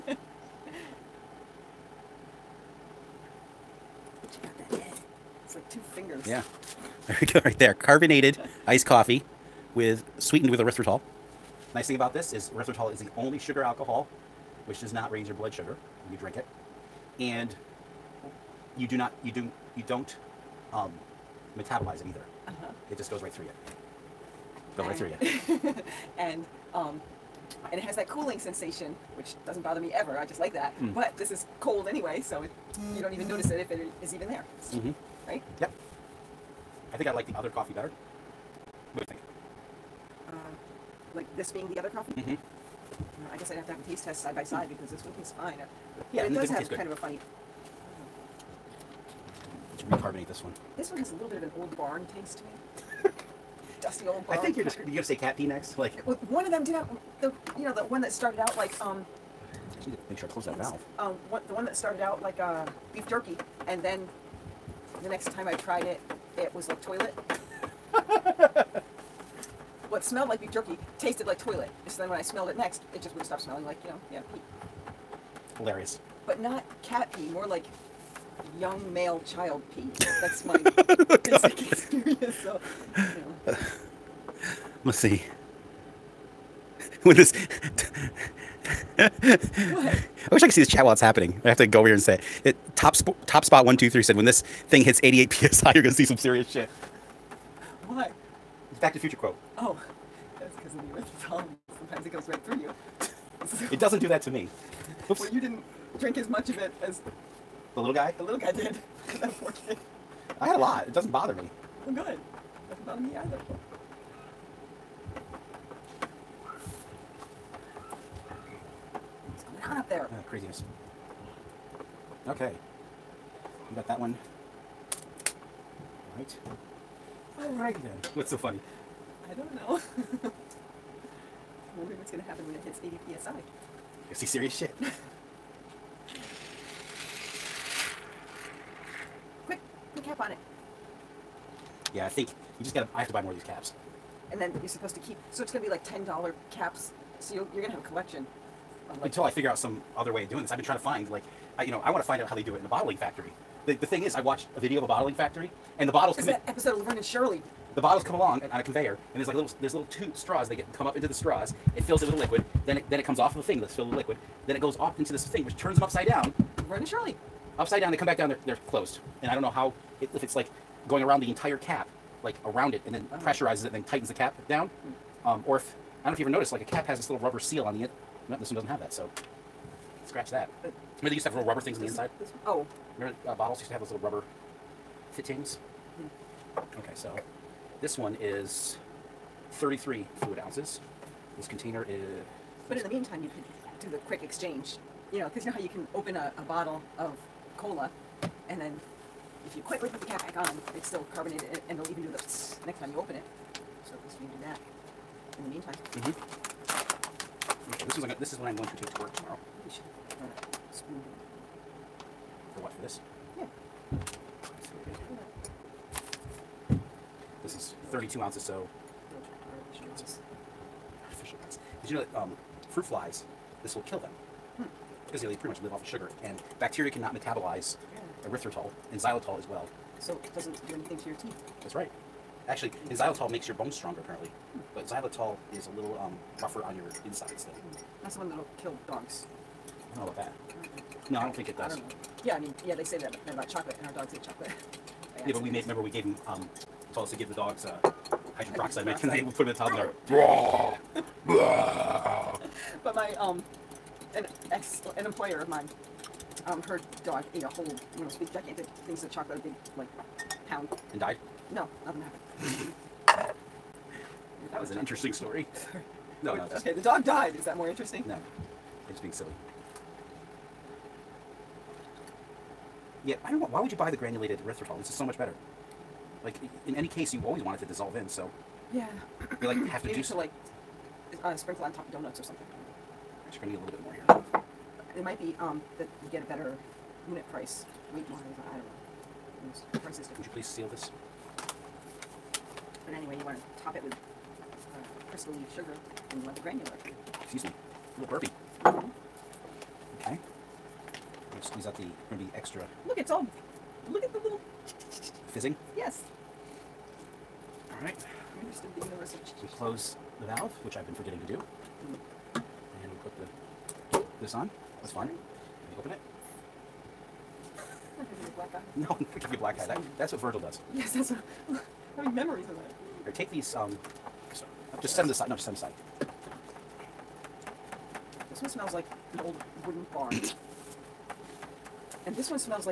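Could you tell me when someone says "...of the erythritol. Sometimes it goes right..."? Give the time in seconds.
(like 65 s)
100 s.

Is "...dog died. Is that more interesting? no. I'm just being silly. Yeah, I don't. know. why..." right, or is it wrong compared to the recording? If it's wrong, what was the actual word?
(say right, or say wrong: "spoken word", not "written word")
right.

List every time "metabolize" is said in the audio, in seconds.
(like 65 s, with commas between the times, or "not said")
21 s, 227 s.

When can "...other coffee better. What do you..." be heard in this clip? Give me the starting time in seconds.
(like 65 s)
37 s.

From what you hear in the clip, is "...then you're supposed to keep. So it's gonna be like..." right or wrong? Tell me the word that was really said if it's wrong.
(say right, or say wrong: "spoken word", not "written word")
right.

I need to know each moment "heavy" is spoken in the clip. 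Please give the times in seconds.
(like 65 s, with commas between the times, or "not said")
not said.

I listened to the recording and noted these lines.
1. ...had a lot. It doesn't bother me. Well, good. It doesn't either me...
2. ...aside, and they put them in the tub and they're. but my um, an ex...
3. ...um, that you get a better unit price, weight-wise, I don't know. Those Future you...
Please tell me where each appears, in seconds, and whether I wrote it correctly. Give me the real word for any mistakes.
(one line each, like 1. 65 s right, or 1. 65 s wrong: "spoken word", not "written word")
1. 110 s wrong: "bother", not "either"
2. 248 s wrong: "peroxide", not "aside"
3. 285 s wrong: "Would", not "Future".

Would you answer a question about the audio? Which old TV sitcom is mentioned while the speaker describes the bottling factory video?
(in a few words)
Laverne and Shirley.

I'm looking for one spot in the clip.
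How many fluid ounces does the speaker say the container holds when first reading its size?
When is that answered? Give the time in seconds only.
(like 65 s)
189 s.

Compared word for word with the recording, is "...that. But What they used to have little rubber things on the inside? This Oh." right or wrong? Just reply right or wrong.
wrong.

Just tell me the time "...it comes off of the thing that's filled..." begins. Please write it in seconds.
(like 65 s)
162 s.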